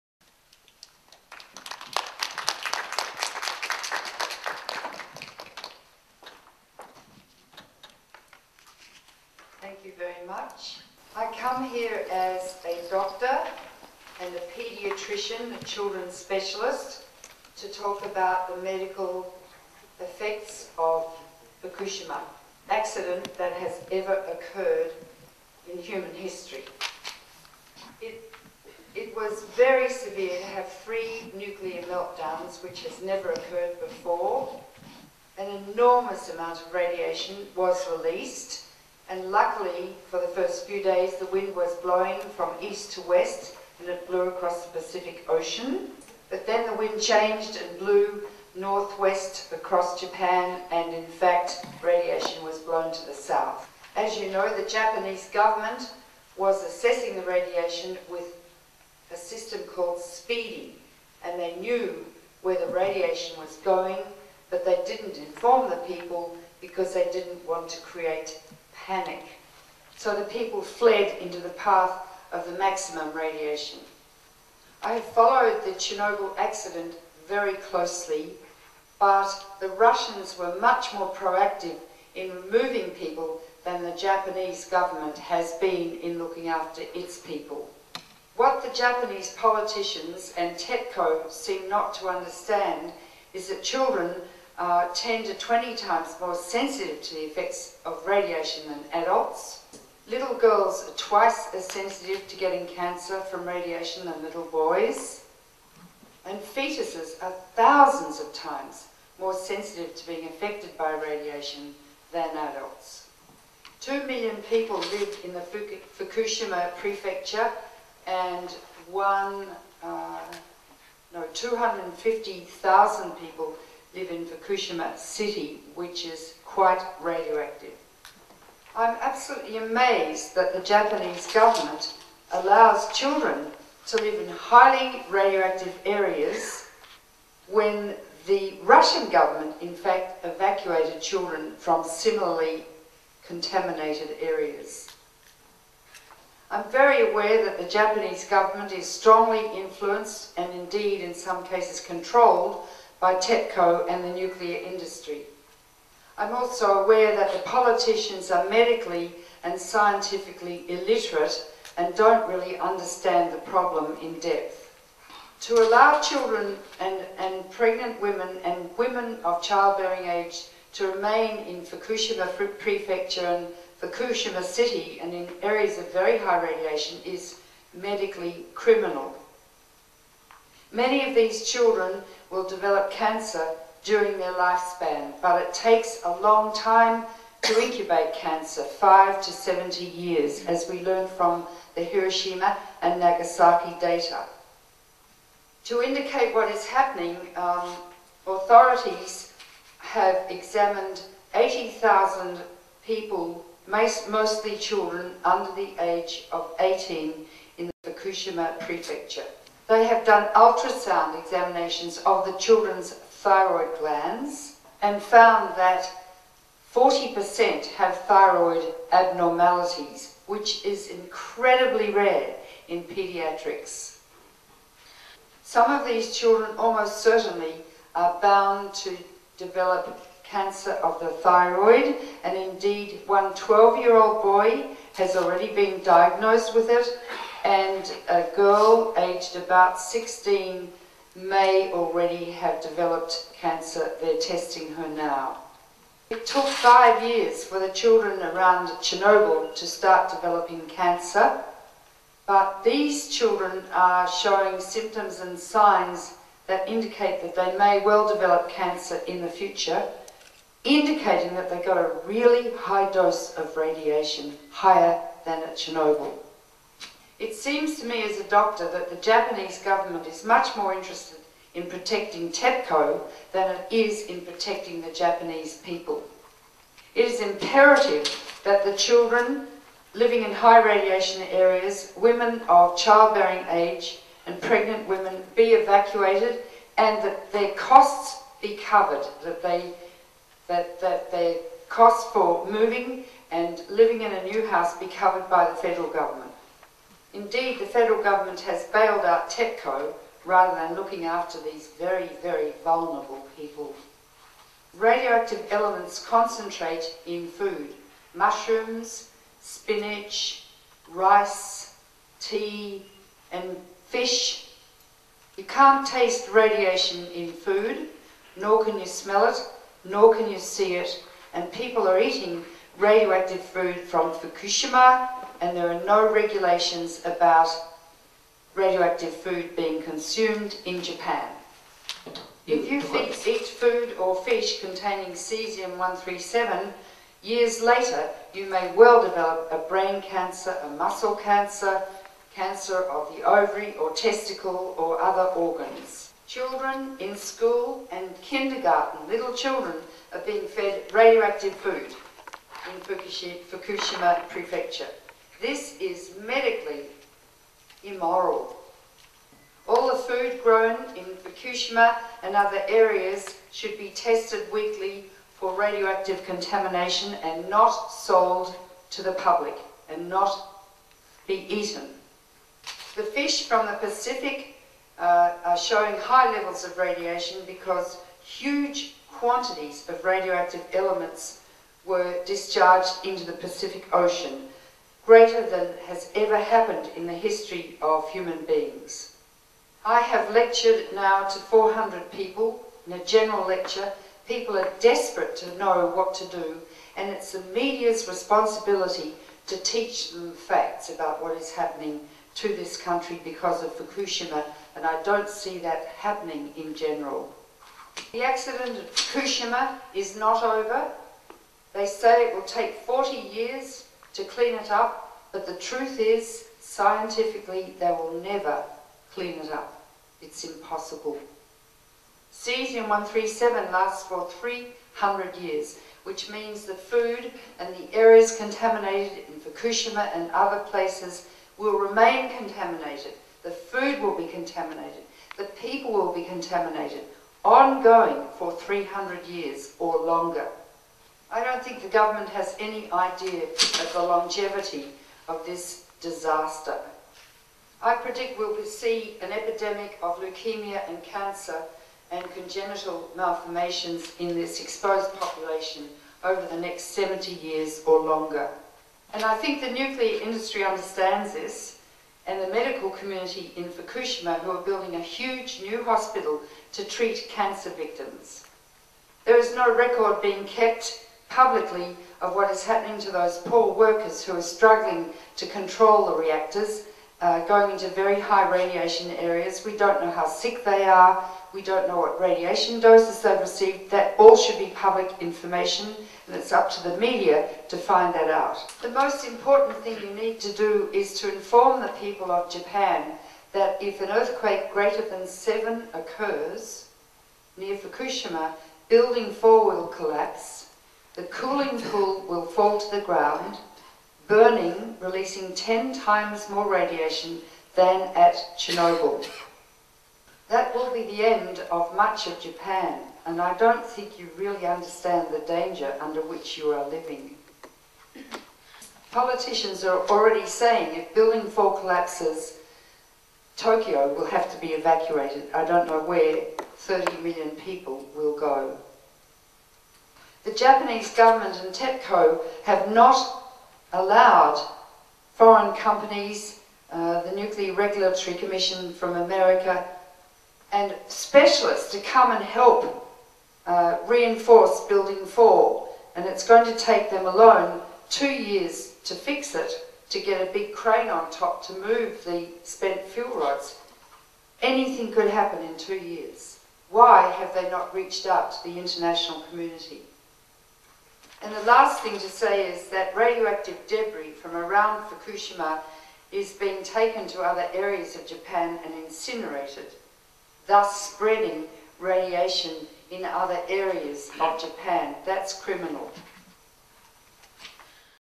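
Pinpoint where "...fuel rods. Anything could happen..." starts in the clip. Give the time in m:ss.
9:13.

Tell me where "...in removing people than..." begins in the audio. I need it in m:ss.
1:22.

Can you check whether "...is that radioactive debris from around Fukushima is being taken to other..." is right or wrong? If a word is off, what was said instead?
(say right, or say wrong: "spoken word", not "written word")
right.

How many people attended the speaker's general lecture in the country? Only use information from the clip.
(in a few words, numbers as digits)
400.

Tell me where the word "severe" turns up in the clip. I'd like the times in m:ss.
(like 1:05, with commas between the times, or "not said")
0:29.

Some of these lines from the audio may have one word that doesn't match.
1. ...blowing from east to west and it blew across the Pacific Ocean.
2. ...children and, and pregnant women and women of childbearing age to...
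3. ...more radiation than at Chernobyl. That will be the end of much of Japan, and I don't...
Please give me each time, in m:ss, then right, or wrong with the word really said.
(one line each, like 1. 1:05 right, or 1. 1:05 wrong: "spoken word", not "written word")
1. 0:41 right
2. 2:46 right
3. 8:26 right.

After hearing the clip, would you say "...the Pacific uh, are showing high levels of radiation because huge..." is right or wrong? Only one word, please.
right.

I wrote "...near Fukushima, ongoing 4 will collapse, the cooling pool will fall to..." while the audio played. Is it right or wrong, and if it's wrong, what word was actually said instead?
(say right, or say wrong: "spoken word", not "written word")
wrong: "building", not "ongoing".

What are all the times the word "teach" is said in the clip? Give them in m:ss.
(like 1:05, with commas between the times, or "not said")
6:39.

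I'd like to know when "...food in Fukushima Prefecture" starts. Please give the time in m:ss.
5:51.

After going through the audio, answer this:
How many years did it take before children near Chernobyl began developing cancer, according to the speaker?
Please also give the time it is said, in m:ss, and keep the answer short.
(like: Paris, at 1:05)
5, at 4:06.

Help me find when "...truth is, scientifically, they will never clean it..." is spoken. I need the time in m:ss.
6:55.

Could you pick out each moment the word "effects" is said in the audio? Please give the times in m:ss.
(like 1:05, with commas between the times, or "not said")
0:19, 1:37.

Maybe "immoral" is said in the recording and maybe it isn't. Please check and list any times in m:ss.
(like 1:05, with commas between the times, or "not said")
5:57.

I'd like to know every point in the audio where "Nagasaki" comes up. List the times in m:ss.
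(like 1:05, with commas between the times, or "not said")
3:13.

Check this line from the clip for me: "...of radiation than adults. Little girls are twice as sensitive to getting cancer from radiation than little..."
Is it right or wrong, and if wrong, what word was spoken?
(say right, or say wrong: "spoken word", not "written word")
right.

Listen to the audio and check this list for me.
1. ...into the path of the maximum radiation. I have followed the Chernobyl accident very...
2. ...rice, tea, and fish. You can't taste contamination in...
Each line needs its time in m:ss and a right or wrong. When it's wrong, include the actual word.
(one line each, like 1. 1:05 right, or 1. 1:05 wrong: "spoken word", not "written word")
1. 1:11 right
2. 5:10 wrong: "radiation", not "contamination".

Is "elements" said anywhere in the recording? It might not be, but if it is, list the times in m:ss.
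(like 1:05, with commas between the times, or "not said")
5:05, 6:20.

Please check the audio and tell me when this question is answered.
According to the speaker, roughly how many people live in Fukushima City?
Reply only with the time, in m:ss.
2:01.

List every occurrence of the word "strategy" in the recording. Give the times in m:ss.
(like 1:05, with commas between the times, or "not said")
not said.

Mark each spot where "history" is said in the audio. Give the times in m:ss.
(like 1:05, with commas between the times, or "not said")
0:26, 6:27.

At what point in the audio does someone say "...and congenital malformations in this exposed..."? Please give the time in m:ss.
7:32.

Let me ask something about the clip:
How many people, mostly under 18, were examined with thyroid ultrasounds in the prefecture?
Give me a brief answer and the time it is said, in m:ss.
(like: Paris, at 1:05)
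80,000, at 3:21.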